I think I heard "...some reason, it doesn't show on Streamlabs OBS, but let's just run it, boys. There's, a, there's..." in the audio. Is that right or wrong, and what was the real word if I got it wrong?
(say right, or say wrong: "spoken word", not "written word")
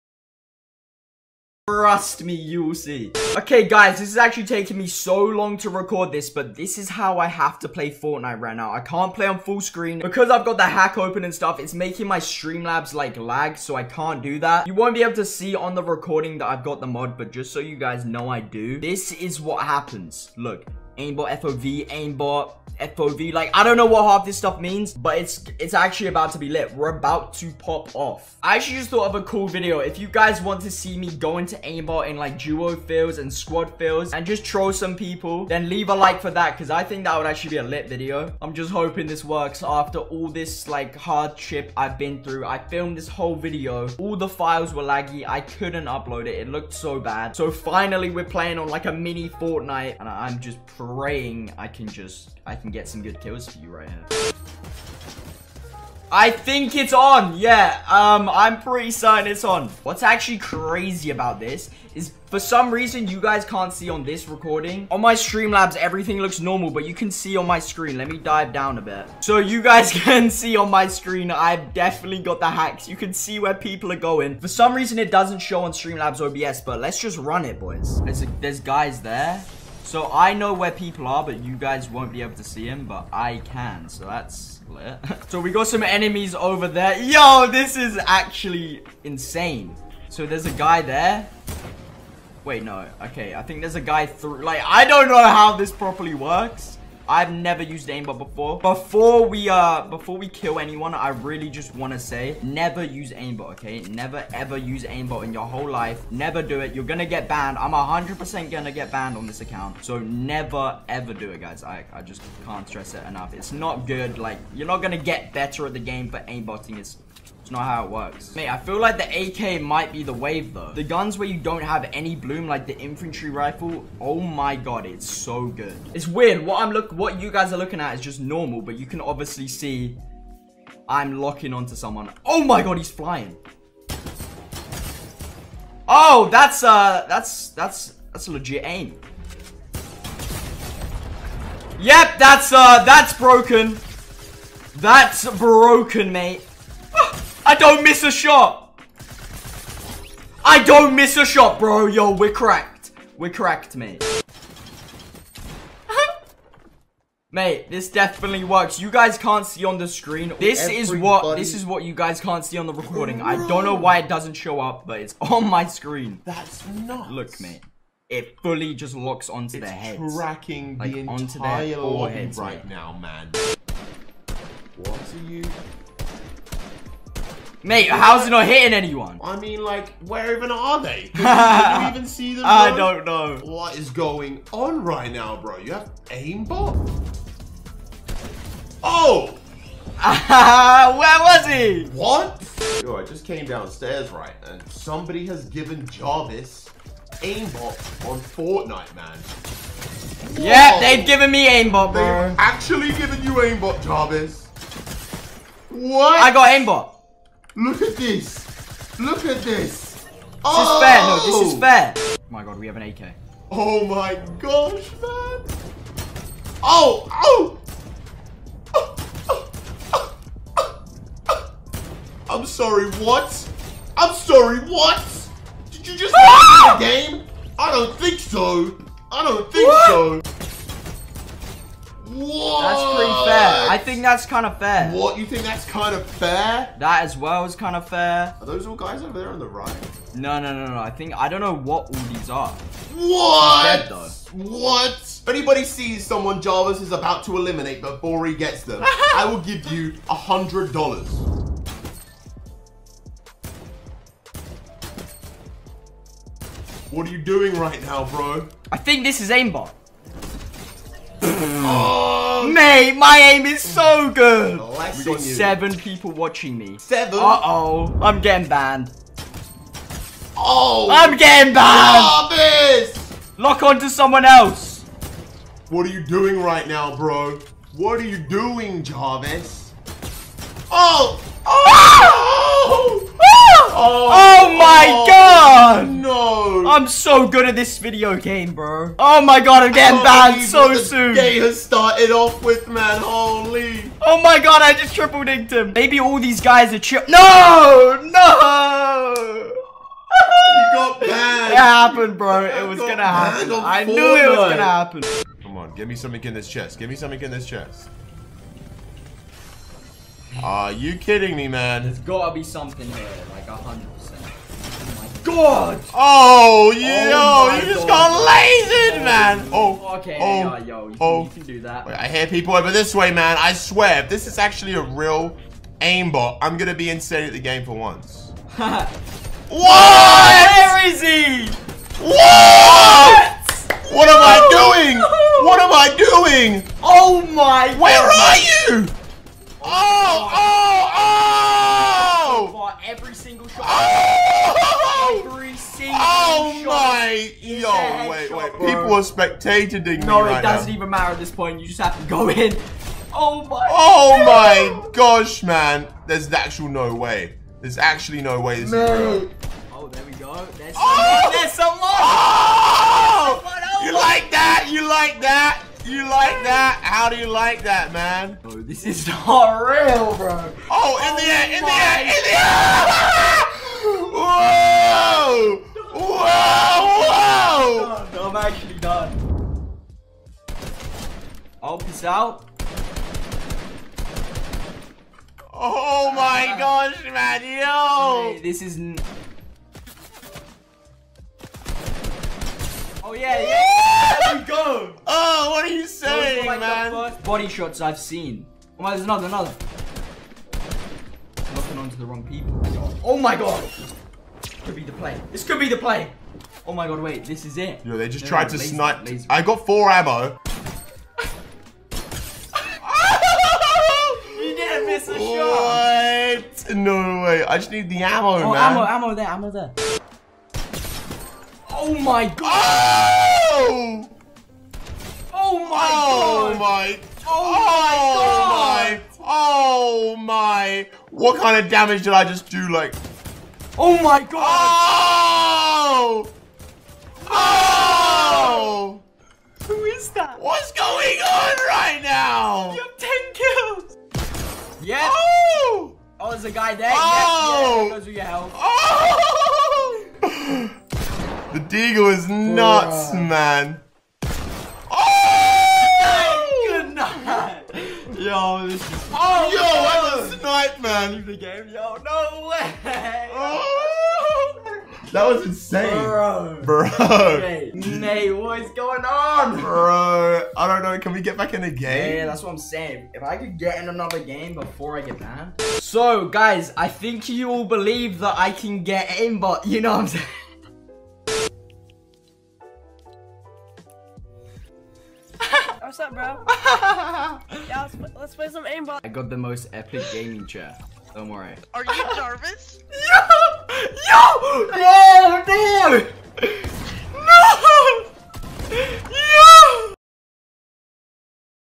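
right.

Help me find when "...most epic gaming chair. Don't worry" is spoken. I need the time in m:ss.
8:09.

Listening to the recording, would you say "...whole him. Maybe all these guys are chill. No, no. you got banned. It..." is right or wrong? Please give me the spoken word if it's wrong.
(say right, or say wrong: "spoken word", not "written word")
wrong: "triple", not "whole".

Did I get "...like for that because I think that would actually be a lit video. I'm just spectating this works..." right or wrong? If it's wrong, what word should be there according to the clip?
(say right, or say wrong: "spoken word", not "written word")
wrong: "hoping", not "spectating".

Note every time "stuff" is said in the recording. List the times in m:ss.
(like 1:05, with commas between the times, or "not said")
0:11, 0:24.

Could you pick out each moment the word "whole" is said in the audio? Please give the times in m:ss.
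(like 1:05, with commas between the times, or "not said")
0:43, 1:45.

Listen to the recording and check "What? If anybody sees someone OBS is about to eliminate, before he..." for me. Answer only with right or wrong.
wrong.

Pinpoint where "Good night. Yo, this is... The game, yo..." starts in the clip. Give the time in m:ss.
7:36.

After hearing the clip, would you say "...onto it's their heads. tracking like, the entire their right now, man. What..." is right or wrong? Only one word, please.
right.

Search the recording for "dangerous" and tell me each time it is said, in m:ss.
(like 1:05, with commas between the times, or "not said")
not said.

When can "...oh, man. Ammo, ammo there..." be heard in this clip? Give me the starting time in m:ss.
6:58.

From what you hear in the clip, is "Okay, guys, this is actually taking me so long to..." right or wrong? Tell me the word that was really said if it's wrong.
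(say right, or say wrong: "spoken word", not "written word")
right.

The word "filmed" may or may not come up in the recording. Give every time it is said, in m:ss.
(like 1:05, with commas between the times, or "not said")
0:42.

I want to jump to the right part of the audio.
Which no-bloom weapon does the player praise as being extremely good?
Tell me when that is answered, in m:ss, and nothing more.
2:02.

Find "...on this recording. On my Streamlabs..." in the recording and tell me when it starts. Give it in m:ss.
1:03.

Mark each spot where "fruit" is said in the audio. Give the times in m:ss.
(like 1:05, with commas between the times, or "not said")
not said.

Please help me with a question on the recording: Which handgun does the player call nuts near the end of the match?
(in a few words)
Deagle.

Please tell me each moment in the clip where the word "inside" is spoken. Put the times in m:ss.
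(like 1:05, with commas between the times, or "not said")
not said.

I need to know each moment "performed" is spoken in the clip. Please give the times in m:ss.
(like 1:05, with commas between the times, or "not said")
not said.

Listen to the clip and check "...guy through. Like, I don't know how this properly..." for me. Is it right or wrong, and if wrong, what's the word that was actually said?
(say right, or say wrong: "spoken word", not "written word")
right.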